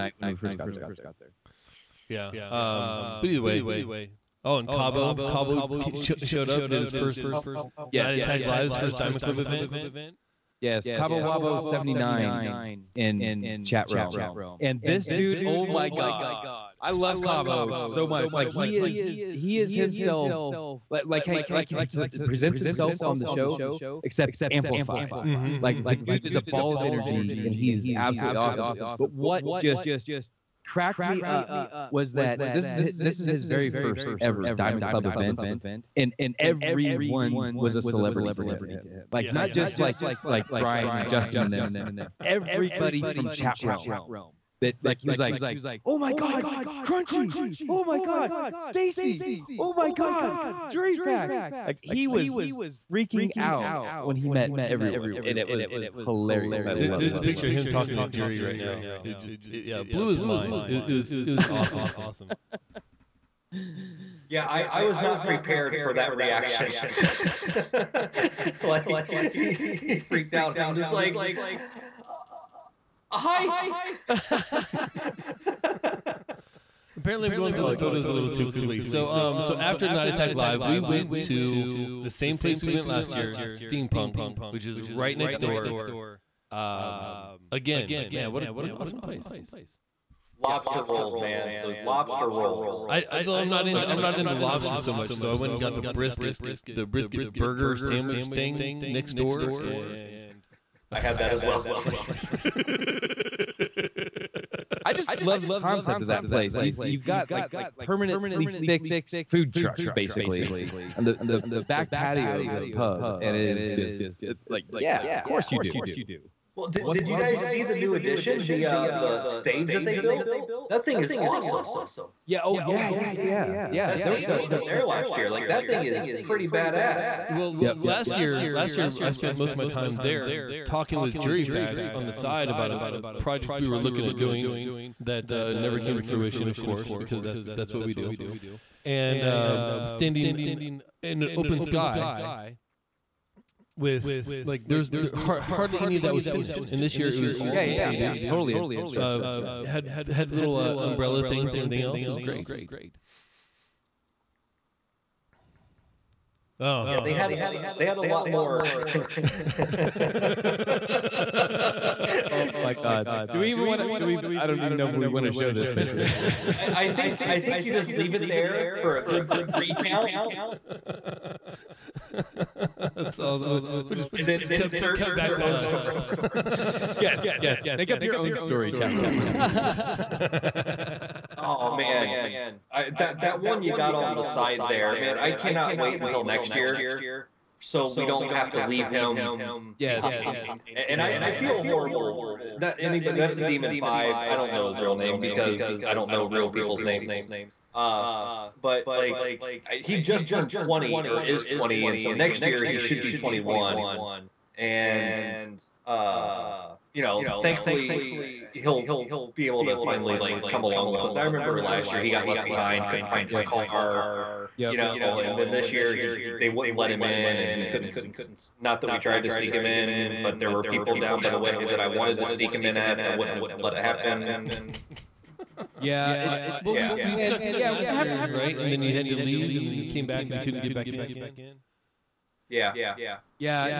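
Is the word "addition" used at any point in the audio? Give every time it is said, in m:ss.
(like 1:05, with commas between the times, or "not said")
1:57.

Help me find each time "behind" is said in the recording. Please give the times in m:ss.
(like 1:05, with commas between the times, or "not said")
3:10, 3:32.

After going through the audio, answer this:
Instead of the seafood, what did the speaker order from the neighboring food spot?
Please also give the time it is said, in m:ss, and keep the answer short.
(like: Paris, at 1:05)
Brisket burger, at 1:36.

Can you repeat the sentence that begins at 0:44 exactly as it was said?
That like he was like, oh my god, Crunchy, oh my god, Stacy, oh my god, Jury Facts.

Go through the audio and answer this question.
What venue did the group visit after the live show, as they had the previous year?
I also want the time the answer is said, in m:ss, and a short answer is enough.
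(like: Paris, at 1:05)
Steampunk, at 1:23.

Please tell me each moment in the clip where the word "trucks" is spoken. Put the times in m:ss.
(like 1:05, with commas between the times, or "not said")
1:49.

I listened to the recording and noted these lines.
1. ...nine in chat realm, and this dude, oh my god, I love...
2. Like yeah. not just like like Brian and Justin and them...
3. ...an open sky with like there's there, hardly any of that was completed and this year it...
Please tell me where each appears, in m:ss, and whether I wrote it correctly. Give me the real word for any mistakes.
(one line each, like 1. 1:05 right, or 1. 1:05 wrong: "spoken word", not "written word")
1. 0:11 right
2. 0:39 right
3. 2:21 wrong: "finished", not "completed".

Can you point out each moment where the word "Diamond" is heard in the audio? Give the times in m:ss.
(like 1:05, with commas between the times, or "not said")
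0:08, 0:34.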